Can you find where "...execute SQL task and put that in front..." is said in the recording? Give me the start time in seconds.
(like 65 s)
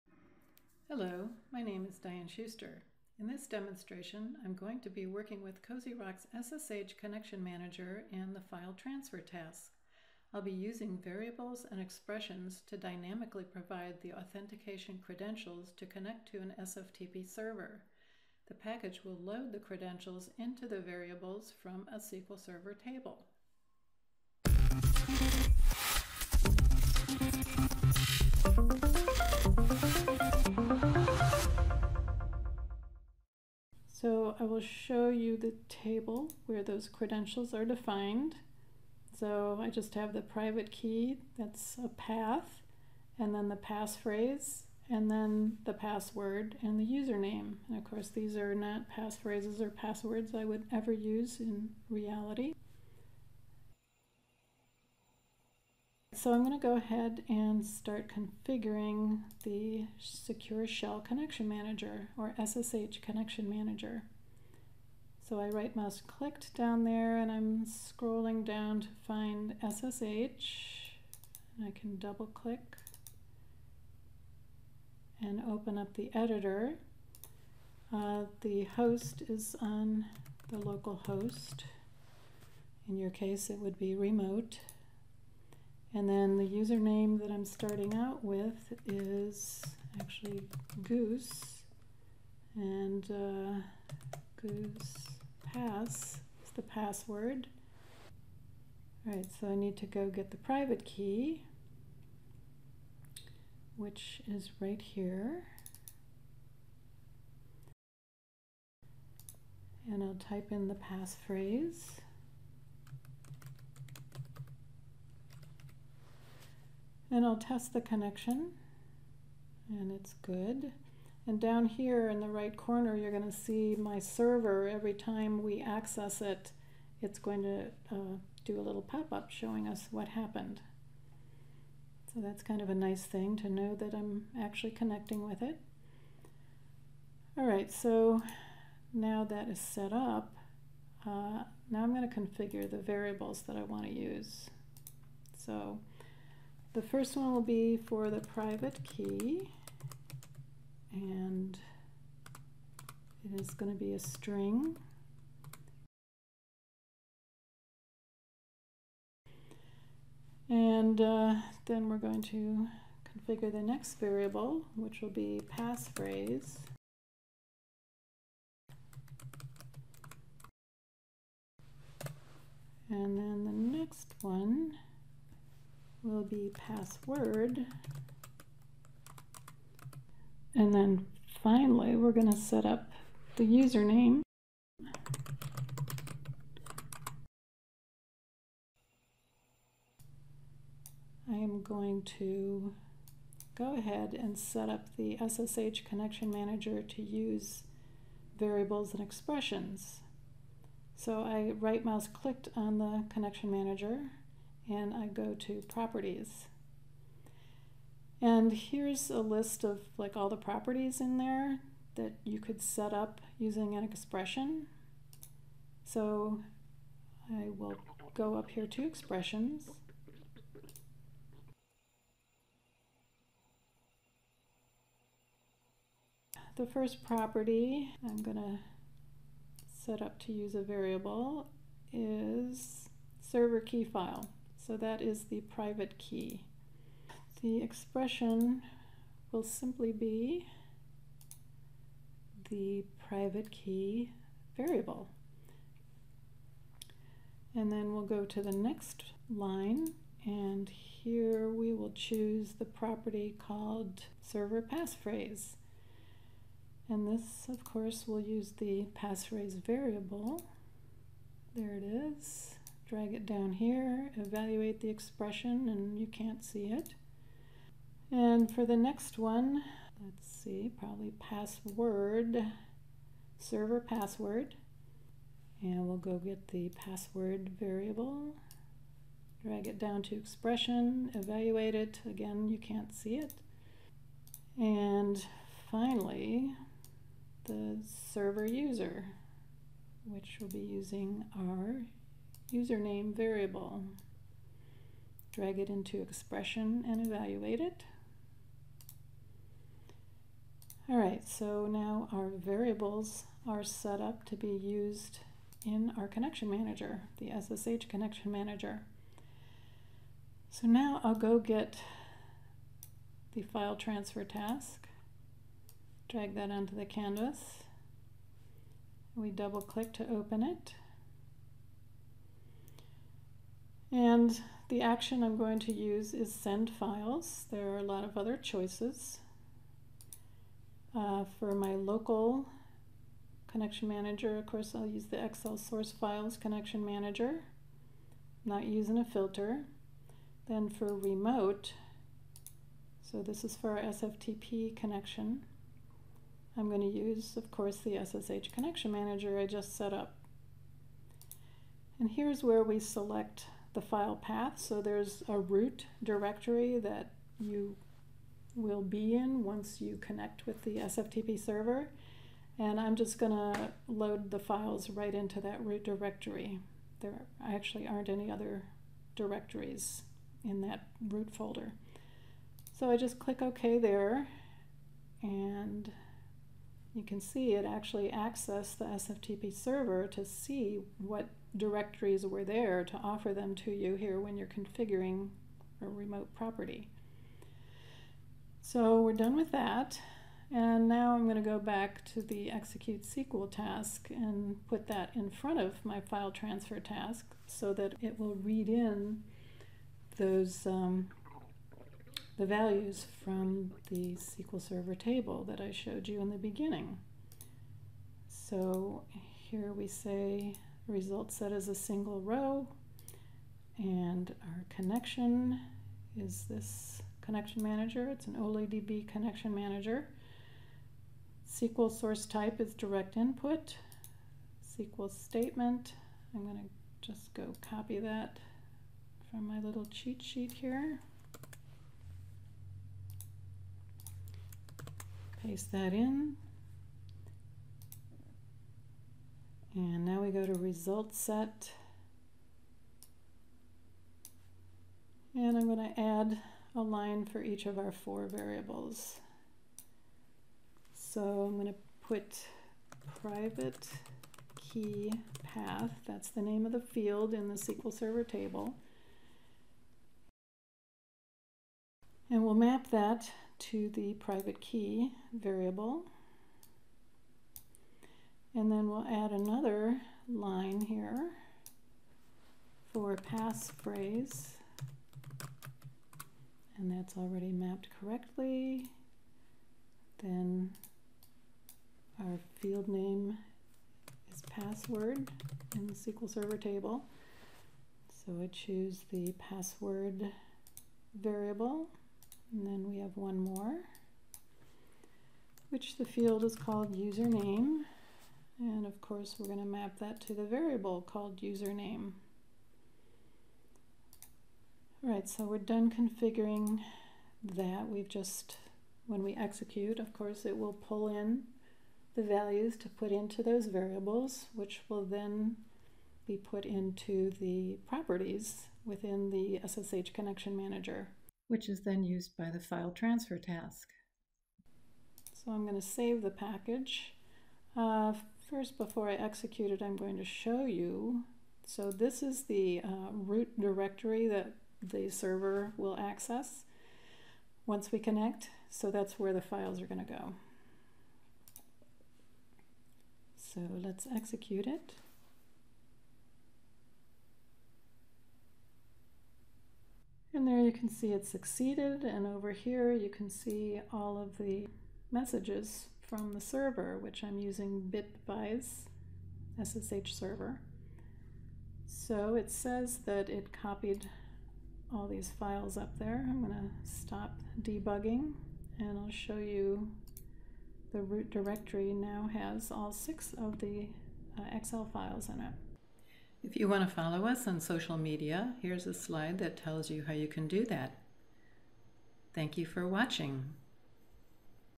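392 s.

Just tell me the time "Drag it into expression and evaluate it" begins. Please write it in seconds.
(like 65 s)
295 s.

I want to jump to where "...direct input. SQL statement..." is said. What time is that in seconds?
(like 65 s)
422 s.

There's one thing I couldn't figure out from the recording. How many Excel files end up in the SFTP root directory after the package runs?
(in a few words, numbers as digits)
6.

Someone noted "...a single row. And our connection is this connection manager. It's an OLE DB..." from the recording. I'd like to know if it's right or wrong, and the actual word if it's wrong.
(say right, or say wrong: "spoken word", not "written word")
right.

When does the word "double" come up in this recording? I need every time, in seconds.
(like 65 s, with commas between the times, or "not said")
71 s, 319 s.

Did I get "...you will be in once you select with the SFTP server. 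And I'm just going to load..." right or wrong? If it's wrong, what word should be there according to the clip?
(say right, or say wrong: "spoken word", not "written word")
wrong: "connect", not "select".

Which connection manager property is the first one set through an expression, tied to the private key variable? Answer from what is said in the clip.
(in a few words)
server key file.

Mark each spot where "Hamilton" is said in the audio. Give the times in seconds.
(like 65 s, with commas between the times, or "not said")
not said.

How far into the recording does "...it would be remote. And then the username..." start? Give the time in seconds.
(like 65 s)
83 s.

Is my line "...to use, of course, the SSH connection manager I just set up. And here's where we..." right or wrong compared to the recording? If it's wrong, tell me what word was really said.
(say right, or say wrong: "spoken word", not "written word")
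right.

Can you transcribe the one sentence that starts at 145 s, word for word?
So the first one will be for the private key, and it is going to be a string.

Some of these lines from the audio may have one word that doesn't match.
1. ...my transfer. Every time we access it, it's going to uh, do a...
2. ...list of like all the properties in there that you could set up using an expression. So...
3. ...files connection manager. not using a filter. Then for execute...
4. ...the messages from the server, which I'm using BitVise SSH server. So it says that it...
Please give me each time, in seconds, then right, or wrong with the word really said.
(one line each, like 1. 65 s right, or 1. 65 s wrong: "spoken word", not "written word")
1. 123 s wrong: "server", not "transfer"
2. 209 s right
3. 335 s wrong: "remote", not "execute"
4. 554 s right.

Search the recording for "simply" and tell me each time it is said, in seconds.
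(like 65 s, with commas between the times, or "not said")
239 s.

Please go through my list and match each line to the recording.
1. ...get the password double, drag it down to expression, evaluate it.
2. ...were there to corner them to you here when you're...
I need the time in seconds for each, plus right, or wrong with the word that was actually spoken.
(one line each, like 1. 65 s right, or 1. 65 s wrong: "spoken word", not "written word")
1. 276 s wrong: "variable", not "double"
2. 382 s wrong: "offer", not "corner".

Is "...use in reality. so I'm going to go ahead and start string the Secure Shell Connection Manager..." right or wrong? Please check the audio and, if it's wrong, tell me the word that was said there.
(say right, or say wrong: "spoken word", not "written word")
wrong: "configuring", not "string".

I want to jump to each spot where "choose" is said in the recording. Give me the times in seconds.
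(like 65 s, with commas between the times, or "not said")
251 s, 488 s.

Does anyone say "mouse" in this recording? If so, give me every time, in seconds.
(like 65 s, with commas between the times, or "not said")
65 s, 201 s.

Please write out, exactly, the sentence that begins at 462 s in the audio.
And we'll map that to the private key variable.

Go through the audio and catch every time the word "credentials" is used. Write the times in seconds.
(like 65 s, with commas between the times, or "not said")
15 s, 19 s, 36 s.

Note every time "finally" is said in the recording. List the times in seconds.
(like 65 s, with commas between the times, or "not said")
181 s, 285 s.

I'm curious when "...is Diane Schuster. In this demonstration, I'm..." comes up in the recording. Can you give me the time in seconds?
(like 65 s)
1 s.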